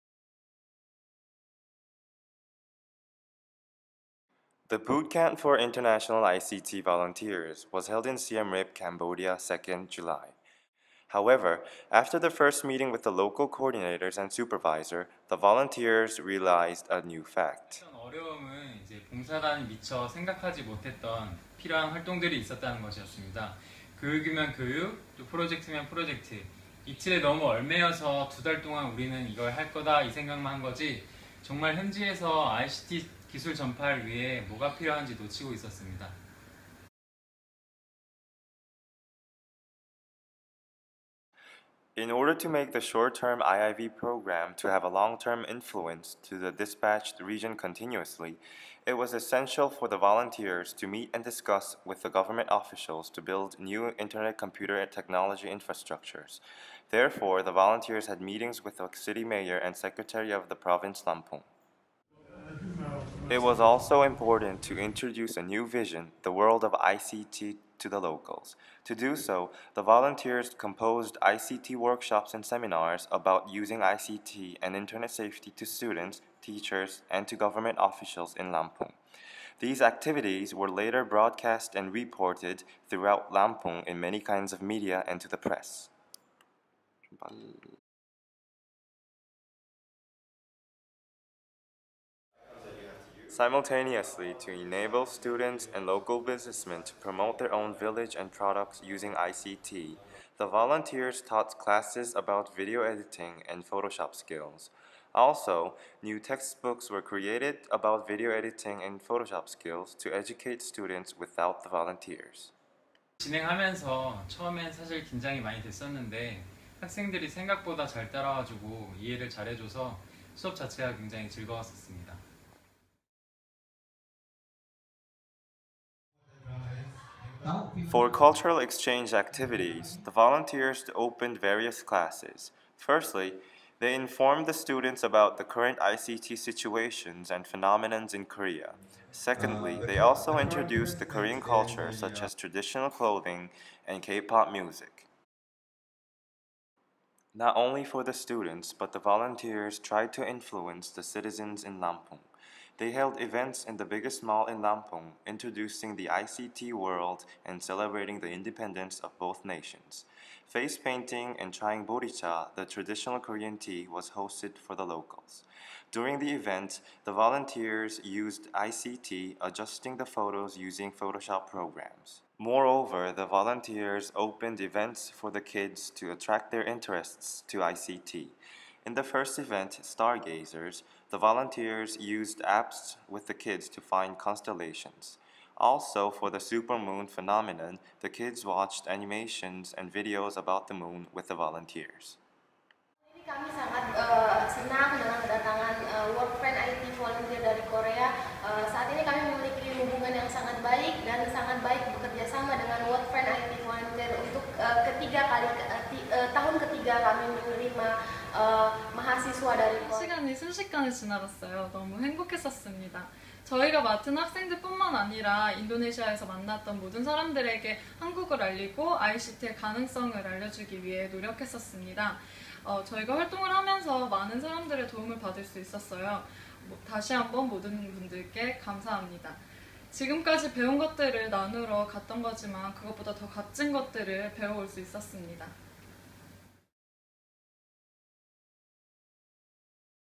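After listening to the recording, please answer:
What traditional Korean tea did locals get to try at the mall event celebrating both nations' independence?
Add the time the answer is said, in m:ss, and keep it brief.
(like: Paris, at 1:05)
boricha, at 2:41.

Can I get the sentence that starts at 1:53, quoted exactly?
진행하면서 처음엔 사실 긴장이 많이 됐었는데 학생들이 생각보다 잘 따라와주고 이해를 잘해줘서 수업 자체가 굉장히 즐거웠었습니다.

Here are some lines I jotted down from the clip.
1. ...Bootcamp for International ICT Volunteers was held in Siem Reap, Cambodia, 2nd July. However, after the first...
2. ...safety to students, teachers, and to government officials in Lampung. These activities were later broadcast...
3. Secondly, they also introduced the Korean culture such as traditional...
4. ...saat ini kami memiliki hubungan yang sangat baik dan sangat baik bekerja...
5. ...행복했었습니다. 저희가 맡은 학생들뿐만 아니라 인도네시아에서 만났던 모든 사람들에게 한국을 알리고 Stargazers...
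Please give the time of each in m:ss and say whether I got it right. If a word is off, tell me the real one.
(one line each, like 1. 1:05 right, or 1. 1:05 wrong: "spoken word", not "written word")
1. 0:04 right
2. 1:15 right
3. 2:19 right
4. 3:18 right
5. 3:31 wrong: "ICT의", not "Stargazers".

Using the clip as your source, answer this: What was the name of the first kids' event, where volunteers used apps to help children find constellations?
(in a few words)
Stargazers.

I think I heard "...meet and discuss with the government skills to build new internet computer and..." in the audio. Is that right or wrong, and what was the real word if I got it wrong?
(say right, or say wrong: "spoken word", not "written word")
wrong: "officials", not "skills".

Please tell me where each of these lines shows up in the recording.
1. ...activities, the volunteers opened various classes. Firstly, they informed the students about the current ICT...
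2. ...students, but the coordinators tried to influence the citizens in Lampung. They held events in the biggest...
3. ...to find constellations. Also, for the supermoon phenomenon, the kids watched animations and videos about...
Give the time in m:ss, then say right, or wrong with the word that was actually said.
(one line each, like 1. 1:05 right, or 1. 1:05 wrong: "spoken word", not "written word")
1. 2:09 right
2. 2:28 wrong: "volunteers", not "coordinators"
3. 3:03 right.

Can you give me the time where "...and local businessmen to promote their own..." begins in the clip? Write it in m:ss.
1:35.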